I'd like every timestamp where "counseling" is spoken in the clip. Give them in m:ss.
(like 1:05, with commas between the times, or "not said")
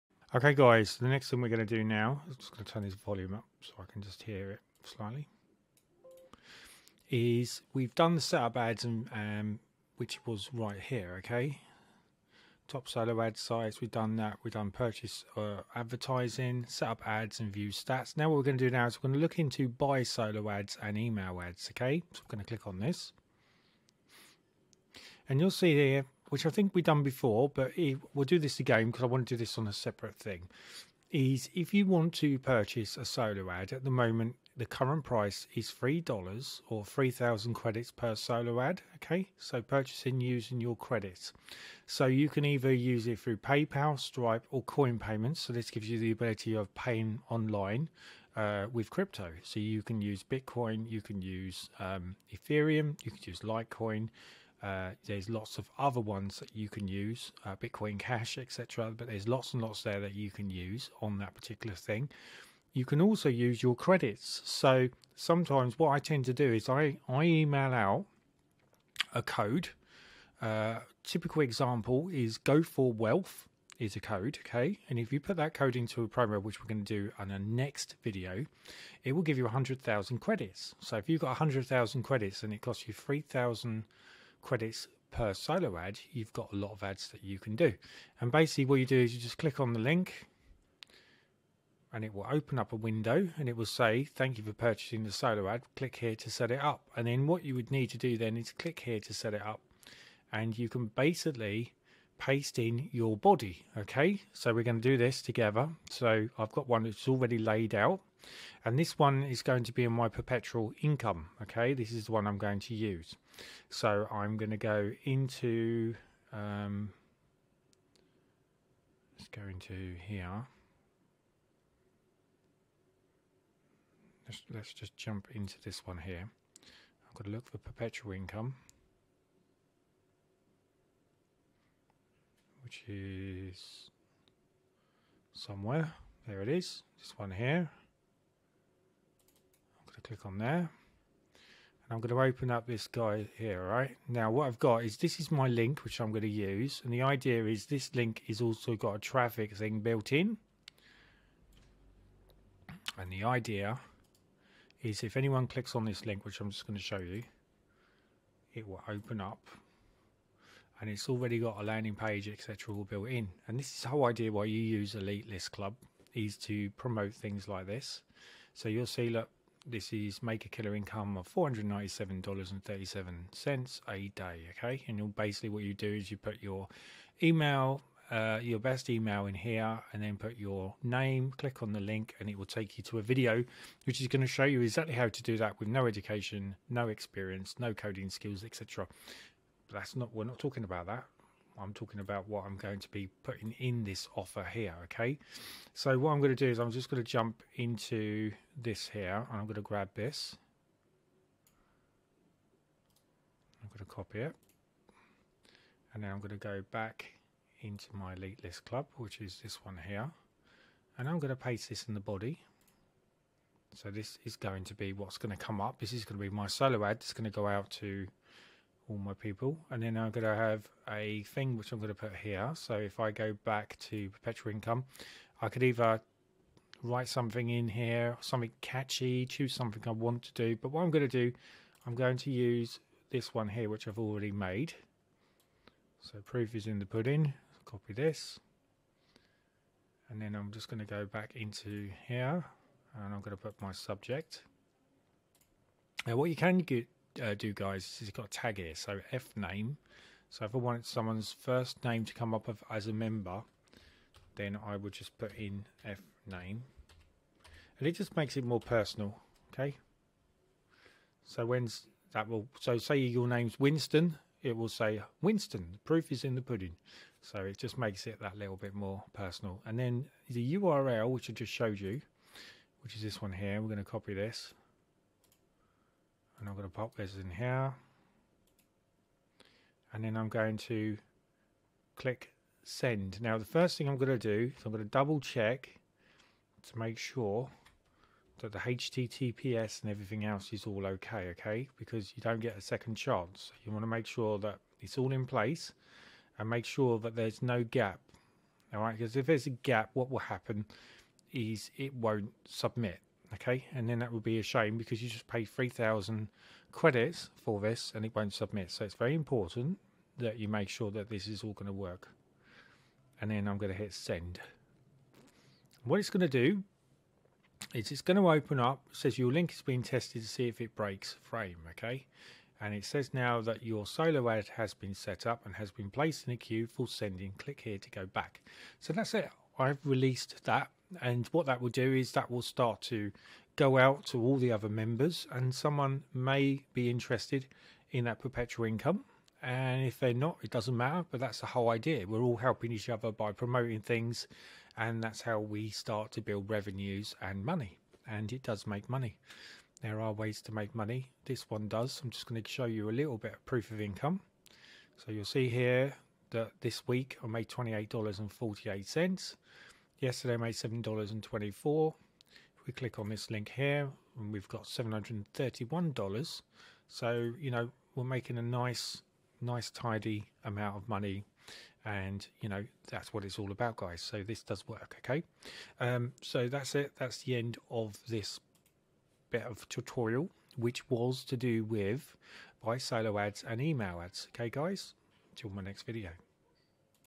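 not said.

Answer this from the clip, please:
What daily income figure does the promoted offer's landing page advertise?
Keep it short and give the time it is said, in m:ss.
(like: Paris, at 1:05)
$497.37, at 2:51.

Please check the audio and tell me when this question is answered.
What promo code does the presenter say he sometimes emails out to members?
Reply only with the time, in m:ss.
1:12.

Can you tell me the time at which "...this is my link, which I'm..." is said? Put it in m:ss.
2:24.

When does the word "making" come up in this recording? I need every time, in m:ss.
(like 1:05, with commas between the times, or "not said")
6:08.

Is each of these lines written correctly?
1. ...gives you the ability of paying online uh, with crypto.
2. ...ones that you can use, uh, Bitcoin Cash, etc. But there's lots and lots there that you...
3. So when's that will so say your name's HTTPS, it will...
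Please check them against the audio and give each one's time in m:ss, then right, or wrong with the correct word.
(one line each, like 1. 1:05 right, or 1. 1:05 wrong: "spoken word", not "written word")
1. 0:45 right
2. 0:55 right
3. 4:21 wrong: "Winston", not "HTTPS".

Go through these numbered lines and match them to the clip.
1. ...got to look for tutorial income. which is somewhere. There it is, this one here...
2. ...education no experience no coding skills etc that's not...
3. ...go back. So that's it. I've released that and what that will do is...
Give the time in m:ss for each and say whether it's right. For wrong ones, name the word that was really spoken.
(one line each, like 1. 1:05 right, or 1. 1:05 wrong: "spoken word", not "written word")
1. 2:07 wrong: "perpetual", not "tutorial"
2. 3:05 right
3. 5:27 right.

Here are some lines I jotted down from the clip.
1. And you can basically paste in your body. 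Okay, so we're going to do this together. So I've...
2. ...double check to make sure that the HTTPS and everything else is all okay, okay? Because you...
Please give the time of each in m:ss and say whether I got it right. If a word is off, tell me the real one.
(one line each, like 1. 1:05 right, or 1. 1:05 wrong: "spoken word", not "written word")
1. 1:40 right
2. 4:44 right.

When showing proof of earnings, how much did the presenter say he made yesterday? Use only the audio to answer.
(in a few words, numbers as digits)
$7.24.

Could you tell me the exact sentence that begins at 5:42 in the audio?
We're all helping each other by promoting things, and that's how we start to build revenues and money.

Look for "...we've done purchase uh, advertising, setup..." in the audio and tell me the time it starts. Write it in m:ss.
0:14.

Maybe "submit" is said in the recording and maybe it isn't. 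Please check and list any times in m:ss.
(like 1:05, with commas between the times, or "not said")
5:02, 5:08.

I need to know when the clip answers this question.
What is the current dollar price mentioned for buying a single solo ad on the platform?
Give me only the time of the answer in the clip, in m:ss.
0:35.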